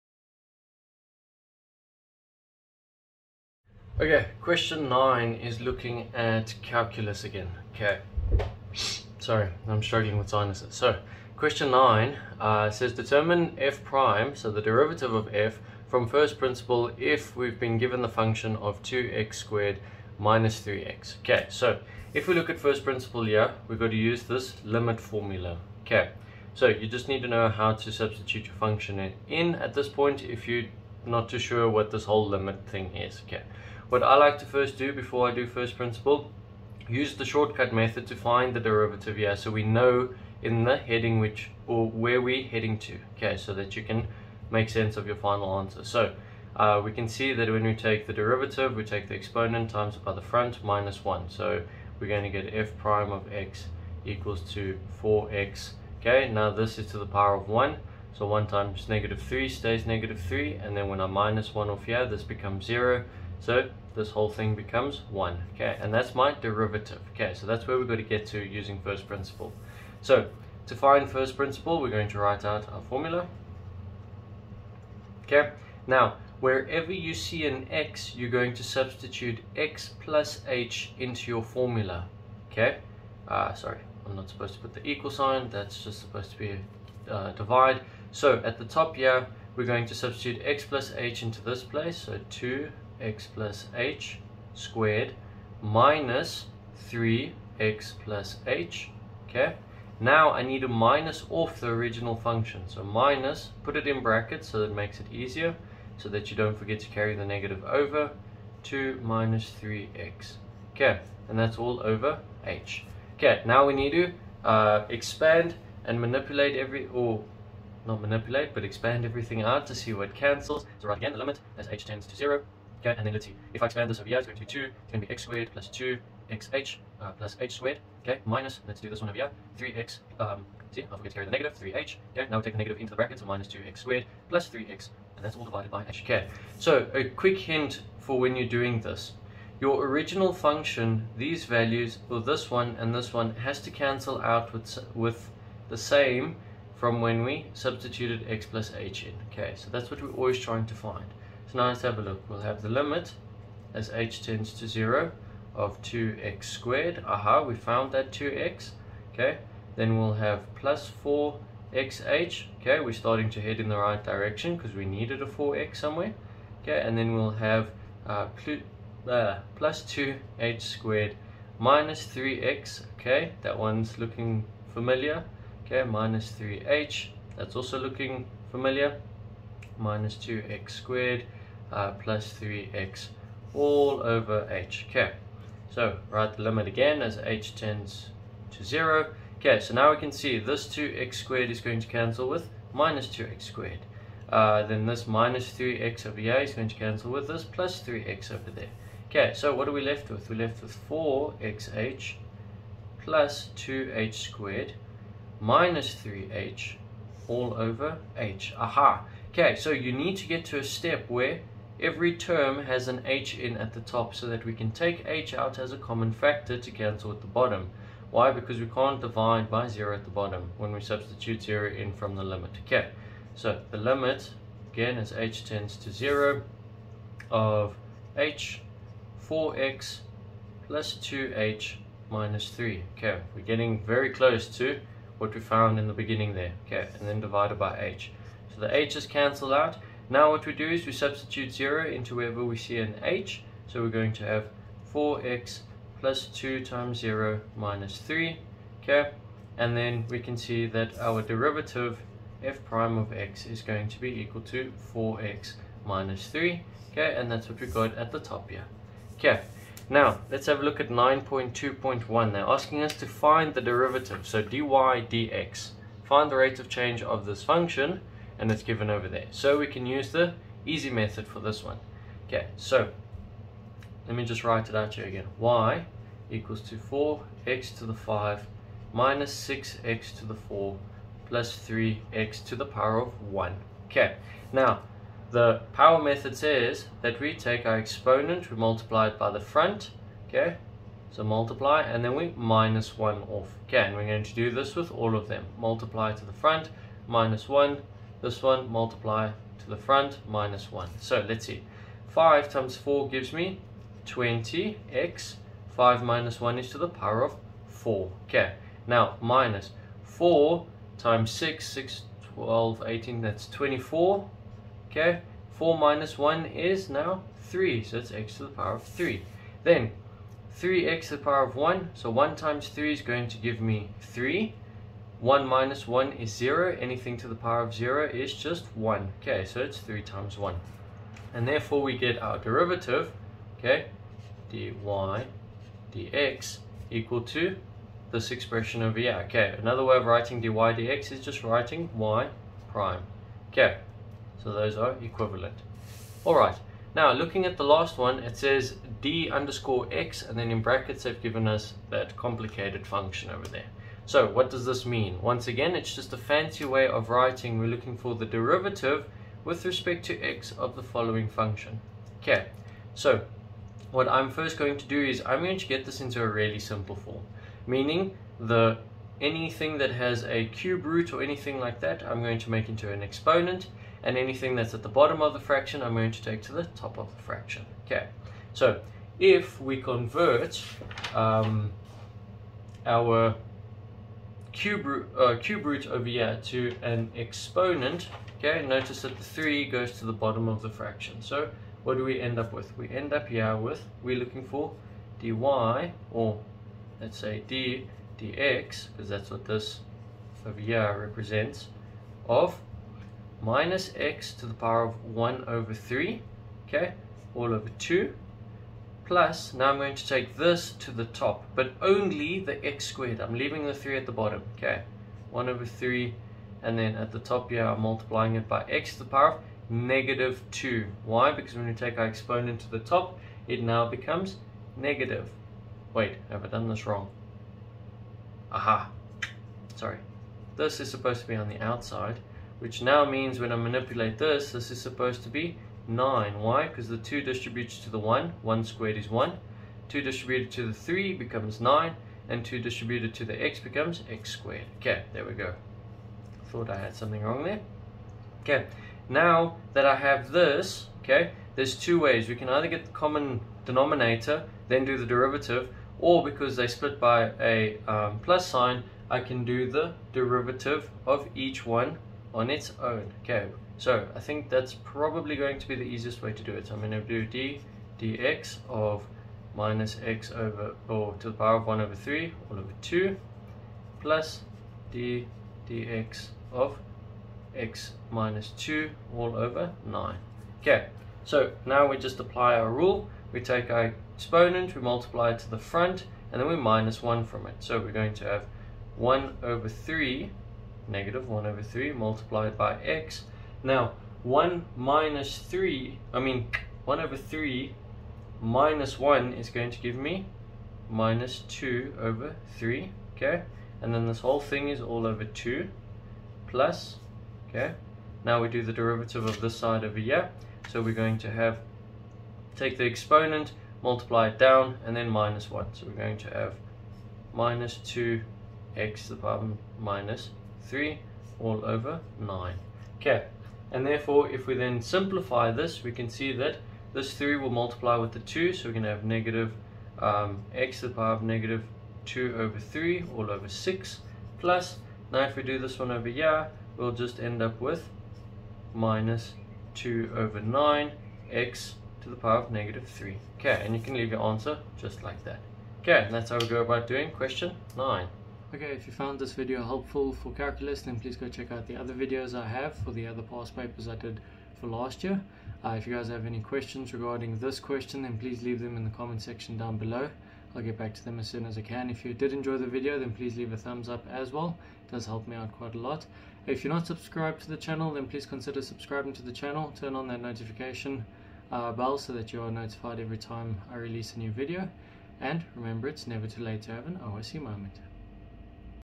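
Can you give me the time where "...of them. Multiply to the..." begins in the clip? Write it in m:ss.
4:55.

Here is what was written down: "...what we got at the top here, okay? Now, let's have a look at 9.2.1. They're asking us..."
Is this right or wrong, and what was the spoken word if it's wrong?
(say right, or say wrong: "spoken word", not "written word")
right.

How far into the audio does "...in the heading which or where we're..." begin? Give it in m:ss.
0:40.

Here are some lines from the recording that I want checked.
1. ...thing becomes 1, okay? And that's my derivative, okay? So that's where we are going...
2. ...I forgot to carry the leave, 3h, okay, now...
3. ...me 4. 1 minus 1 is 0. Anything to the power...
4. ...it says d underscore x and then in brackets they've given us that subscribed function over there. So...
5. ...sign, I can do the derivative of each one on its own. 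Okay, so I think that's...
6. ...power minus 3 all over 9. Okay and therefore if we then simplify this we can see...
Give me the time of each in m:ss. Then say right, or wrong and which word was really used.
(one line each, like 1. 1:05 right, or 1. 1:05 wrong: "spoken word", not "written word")
1. 1:04 right
2. 2:10 wrong: "negative", not "leave"
3. 5:23 wrong: "3", not "4"
4. 5:48 wrong: "complicated", not "subscribed"
5. 7:38 right
6. 8:39 right.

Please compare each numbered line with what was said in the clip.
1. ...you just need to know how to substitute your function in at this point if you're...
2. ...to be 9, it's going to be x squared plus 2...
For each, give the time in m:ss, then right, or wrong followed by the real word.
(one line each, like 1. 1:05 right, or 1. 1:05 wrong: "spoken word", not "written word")
1. 0:26 right
2. 2:04 wrong: "2", not "9".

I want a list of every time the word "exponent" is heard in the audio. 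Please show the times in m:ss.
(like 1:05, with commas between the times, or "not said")
0:49, 4:47, 6:13, 6:27, 7:02, 8:04, 8:32.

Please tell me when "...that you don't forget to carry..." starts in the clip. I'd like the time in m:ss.
1:46.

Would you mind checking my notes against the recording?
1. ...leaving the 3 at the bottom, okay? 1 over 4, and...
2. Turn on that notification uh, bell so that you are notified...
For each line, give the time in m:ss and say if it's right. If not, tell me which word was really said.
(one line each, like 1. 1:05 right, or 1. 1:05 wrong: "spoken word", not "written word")
1. 6:53 wrong: "3", not "4"
2. 9:29 right.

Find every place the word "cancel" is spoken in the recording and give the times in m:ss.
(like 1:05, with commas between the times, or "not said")
2:00, 2:23, 3:11, 3:16, 3:36, 3:59.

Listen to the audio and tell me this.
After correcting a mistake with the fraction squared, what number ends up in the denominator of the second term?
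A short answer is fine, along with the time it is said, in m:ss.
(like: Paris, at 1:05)
9, at 7:14.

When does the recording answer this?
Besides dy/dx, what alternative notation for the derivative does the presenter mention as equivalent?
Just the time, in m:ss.
5:41.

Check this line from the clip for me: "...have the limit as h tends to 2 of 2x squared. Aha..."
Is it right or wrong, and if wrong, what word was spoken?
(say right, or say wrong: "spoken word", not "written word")
wrong: "0", not "2".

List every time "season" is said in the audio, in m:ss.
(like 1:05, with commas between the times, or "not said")
not said.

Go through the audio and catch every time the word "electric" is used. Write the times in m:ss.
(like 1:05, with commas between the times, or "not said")
not said.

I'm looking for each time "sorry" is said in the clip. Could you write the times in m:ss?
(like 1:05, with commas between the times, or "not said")
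0:09, 1:23, 7:09.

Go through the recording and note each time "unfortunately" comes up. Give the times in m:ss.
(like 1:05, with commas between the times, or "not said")
not said.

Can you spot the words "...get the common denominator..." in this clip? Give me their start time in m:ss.
7:32.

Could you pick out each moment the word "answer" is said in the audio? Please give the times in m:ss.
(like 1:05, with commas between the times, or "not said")
0:45, 9:04.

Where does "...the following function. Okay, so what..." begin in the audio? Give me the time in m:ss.
6:00.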